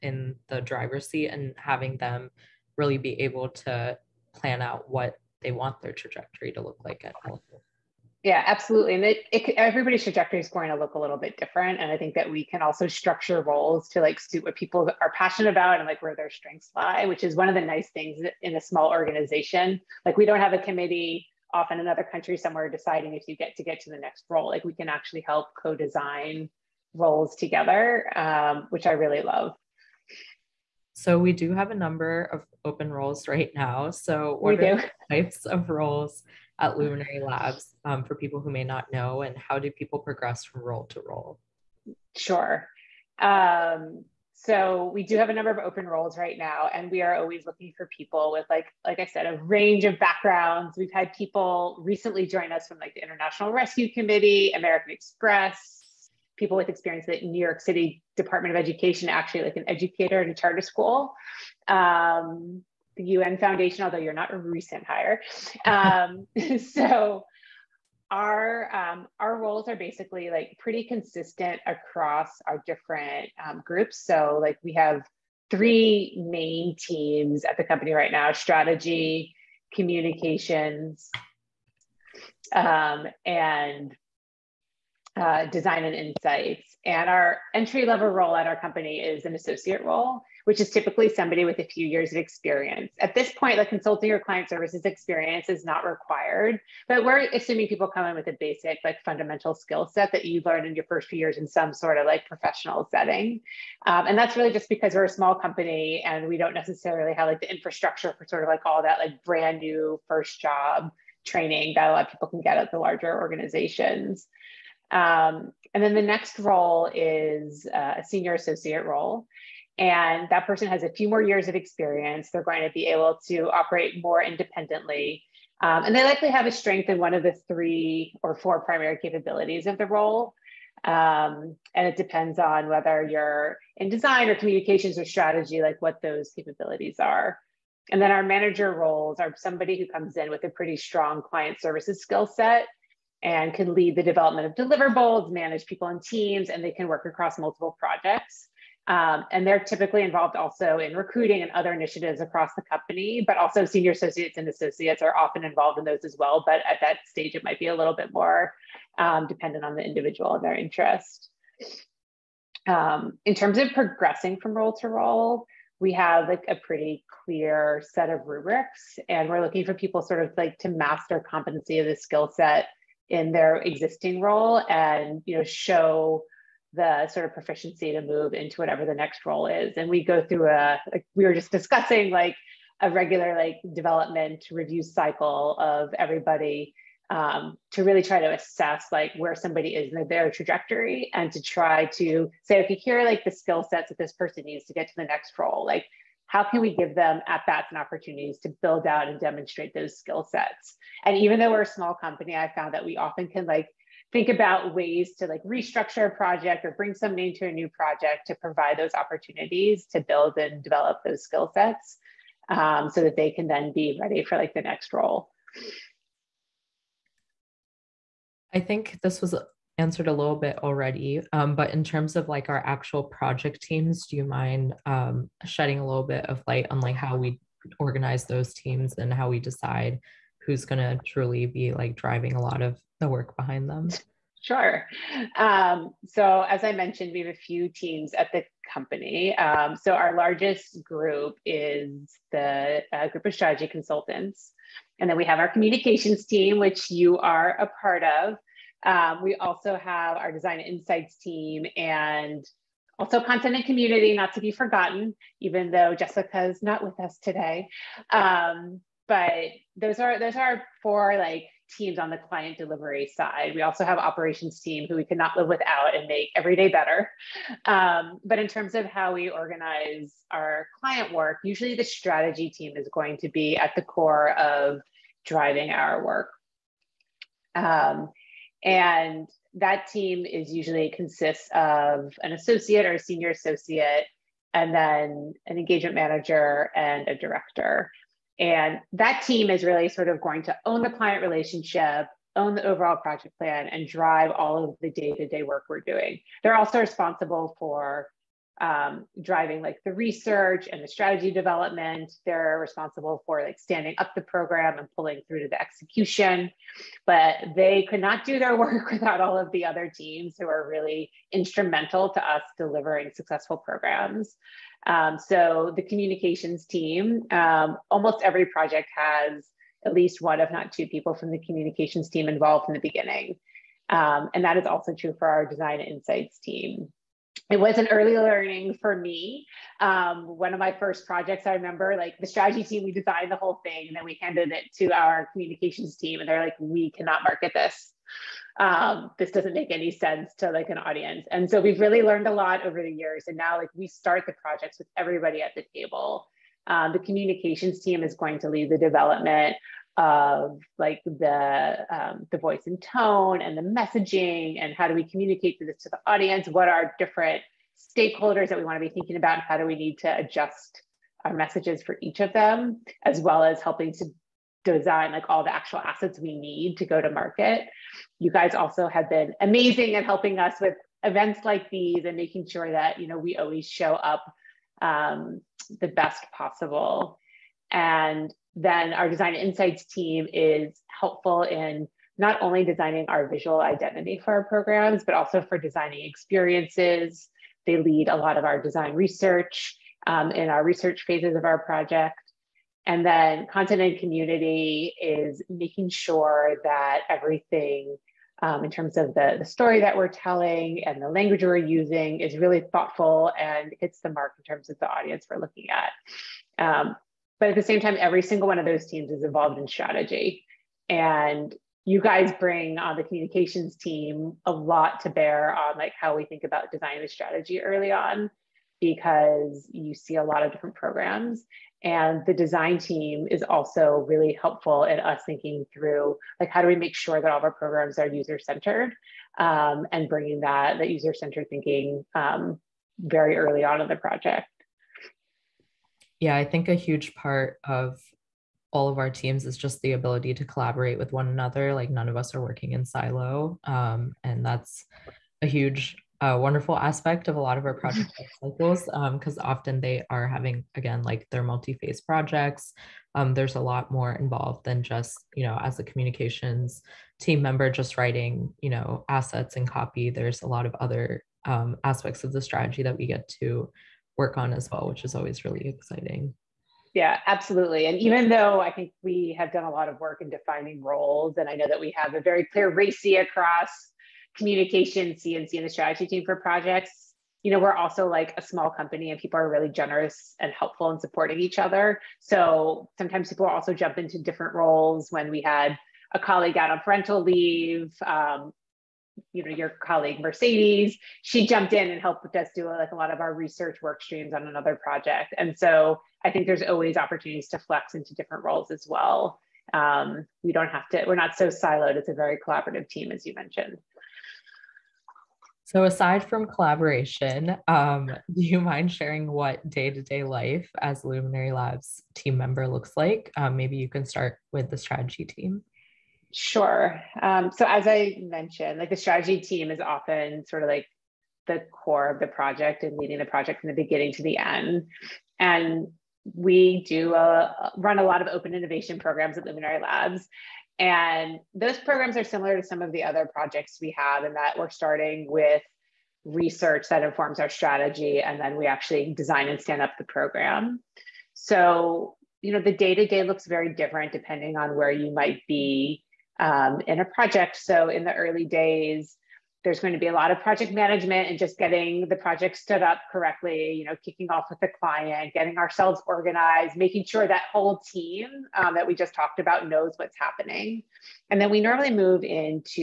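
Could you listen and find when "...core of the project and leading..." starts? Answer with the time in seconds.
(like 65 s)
521 s.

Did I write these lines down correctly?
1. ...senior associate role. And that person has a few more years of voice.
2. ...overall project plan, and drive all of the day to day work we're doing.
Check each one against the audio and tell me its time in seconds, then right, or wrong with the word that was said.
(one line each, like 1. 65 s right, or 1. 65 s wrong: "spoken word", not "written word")
1. 118 s wrong: "experience", not "voice"
2. 292 s right.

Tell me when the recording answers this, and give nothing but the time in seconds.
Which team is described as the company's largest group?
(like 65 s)
243 s.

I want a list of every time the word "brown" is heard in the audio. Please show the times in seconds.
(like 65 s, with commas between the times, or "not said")
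not said.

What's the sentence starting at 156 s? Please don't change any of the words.
But at that stage, it might be a little bit more um, dependent on the individual and their interest.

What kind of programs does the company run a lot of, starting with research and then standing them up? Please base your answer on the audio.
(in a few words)
Open innovation programs.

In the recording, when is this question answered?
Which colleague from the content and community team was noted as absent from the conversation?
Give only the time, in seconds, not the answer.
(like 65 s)
255 s.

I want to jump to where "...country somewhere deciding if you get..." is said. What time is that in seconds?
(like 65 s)
22 s.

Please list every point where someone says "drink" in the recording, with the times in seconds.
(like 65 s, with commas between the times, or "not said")
not said.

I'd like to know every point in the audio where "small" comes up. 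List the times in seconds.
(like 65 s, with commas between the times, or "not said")
18 s, 105 s, 201 s, 478 s.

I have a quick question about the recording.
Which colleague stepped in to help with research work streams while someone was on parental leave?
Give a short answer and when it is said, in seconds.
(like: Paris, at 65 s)
Mercedes, at 490 s.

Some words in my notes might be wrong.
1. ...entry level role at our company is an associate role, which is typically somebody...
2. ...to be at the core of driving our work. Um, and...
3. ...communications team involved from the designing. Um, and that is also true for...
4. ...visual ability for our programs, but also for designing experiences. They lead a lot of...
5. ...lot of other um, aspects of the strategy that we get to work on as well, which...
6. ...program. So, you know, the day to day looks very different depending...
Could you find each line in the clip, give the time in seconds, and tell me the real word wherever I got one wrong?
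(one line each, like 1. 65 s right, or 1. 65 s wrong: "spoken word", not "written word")
1. 87 s right
2. 273 s right
3. 321 s wrong: "beginning", not "designing"
4. 383 s wrong: "identity", not "ability"
5. 460 s right
6. 540 s right.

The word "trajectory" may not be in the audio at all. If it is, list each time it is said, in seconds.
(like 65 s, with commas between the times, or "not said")
5 s, 10 s, 190 s.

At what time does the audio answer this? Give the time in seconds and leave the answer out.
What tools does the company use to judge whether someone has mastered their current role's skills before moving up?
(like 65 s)
168 s.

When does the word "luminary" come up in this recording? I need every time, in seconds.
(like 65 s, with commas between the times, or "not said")
36 s, 511 s, 529 s.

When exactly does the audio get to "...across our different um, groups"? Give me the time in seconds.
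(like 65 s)
71 s.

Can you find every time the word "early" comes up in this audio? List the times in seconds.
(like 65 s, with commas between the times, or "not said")
327 s, 417 s, 433 s, 548 s.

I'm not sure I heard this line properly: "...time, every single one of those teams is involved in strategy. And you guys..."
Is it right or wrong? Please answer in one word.
right.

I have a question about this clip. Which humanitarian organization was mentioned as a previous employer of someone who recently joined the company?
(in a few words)
International Rescue Committee.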